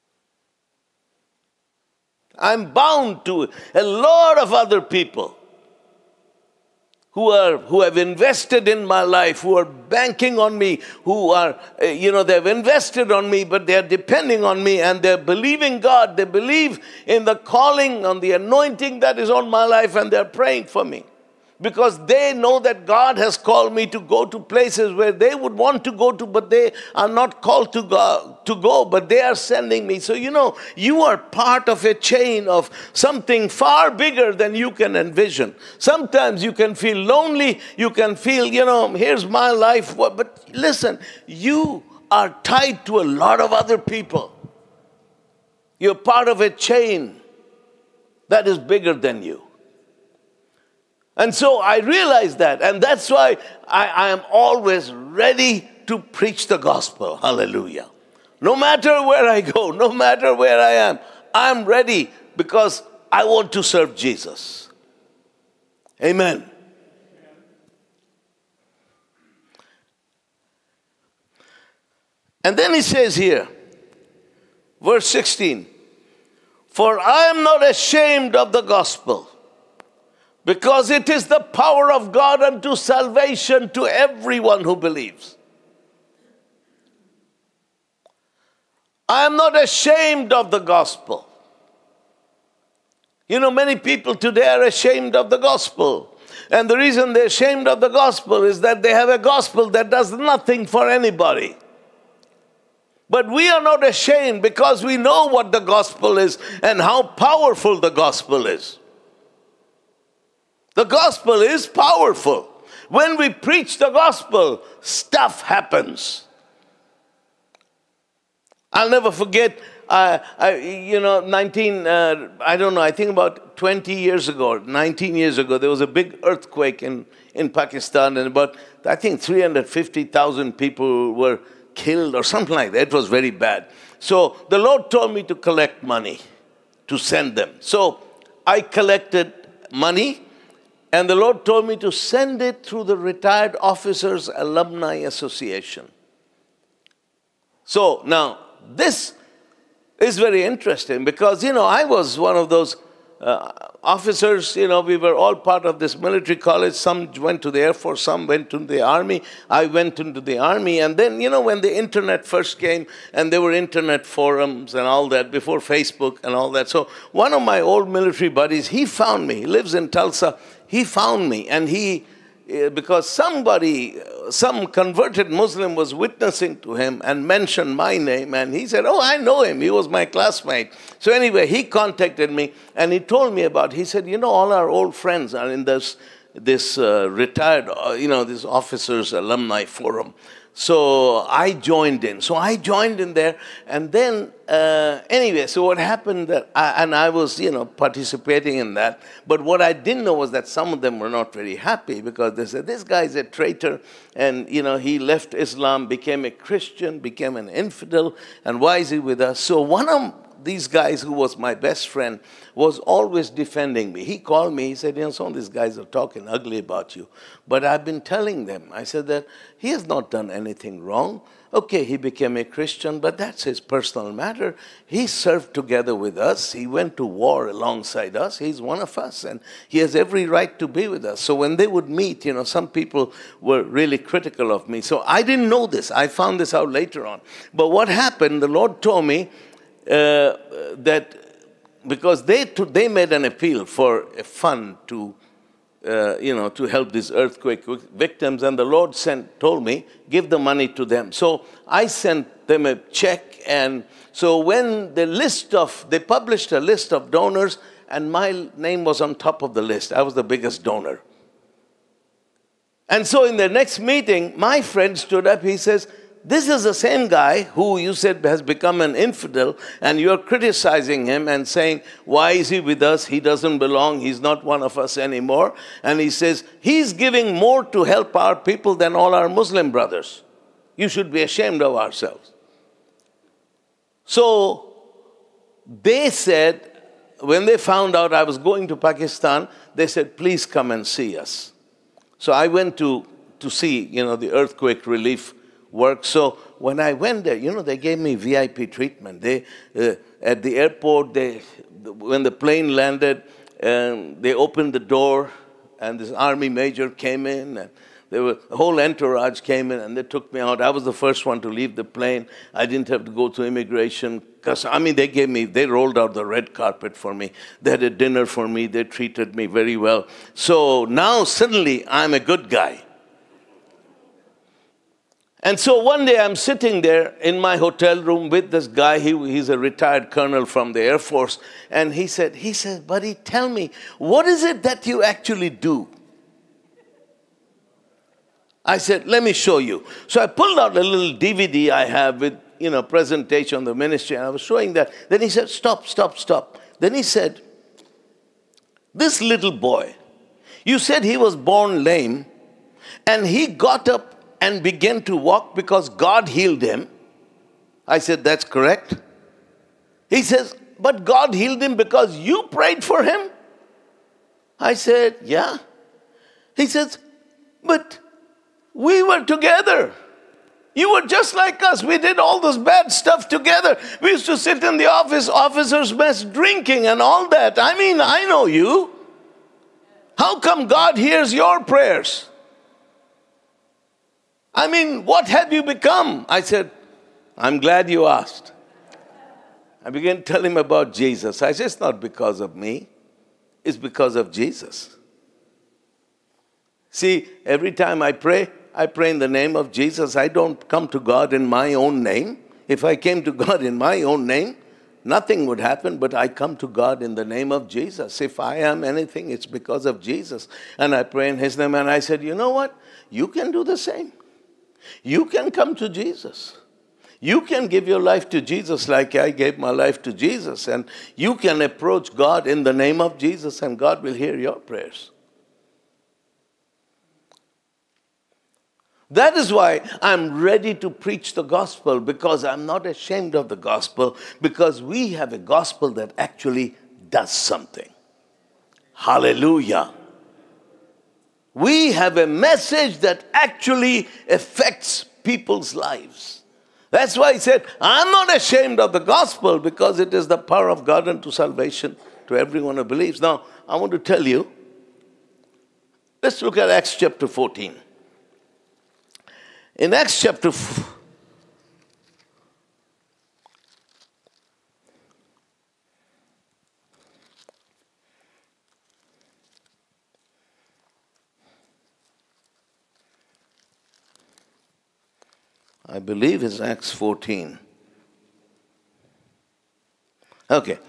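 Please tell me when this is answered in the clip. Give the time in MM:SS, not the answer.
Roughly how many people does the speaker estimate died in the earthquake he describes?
02:09.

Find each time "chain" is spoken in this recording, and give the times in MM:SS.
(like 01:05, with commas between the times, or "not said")
00:31, 00:46.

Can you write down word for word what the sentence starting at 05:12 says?
I didn't have to go through immigration.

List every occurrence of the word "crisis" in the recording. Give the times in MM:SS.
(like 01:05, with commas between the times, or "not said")
not said.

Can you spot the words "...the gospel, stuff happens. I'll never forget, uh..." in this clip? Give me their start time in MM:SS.
01:53.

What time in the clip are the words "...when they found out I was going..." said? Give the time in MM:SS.
04:47.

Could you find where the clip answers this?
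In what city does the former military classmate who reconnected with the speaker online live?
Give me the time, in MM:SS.
02:49.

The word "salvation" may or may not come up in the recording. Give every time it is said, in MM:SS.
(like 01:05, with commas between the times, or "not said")
01:22, 07:31.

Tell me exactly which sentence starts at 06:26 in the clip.
I said, I'm glad you asked.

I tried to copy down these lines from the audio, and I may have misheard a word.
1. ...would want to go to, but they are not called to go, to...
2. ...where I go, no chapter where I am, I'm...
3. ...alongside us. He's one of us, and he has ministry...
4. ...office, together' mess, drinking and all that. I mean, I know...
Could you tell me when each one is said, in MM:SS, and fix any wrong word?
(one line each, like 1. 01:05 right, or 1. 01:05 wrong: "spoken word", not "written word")
1. 00:25 right
2. 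00:59 wrong: "matter", not "chapter"
3. 03:47 wrong: "every", not "ministry"
4. 06:14 wrong: "officers", not "together".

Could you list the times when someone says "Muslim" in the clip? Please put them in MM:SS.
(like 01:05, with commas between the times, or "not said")
02:55, 04:39.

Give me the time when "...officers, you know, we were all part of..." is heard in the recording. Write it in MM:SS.
02:33.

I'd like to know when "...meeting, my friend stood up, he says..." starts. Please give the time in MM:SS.
04:23.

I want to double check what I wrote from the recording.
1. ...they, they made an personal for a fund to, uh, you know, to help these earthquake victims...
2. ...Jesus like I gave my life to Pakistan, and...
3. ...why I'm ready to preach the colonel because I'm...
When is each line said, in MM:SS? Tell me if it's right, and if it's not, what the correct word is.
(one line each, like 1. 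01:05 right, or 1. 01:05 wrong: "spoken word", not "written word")
1. 04:02 wrong: "appeal", not "personal"
2. 06:58 wrong: "Jesus", not "Pakistan"
3. 07:09 wrong: "gospel", not "colonel".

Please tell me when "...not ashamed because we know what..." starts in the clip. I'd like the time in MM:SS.
01:43.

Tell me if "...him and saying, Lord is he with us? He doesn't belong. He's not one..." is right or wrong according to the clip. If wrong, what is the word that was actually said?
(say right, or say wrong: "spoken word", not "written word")
wrong: "Why", not "Lord".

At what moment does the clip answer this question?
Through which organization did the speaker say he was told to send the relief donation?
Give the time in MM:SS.
02:22.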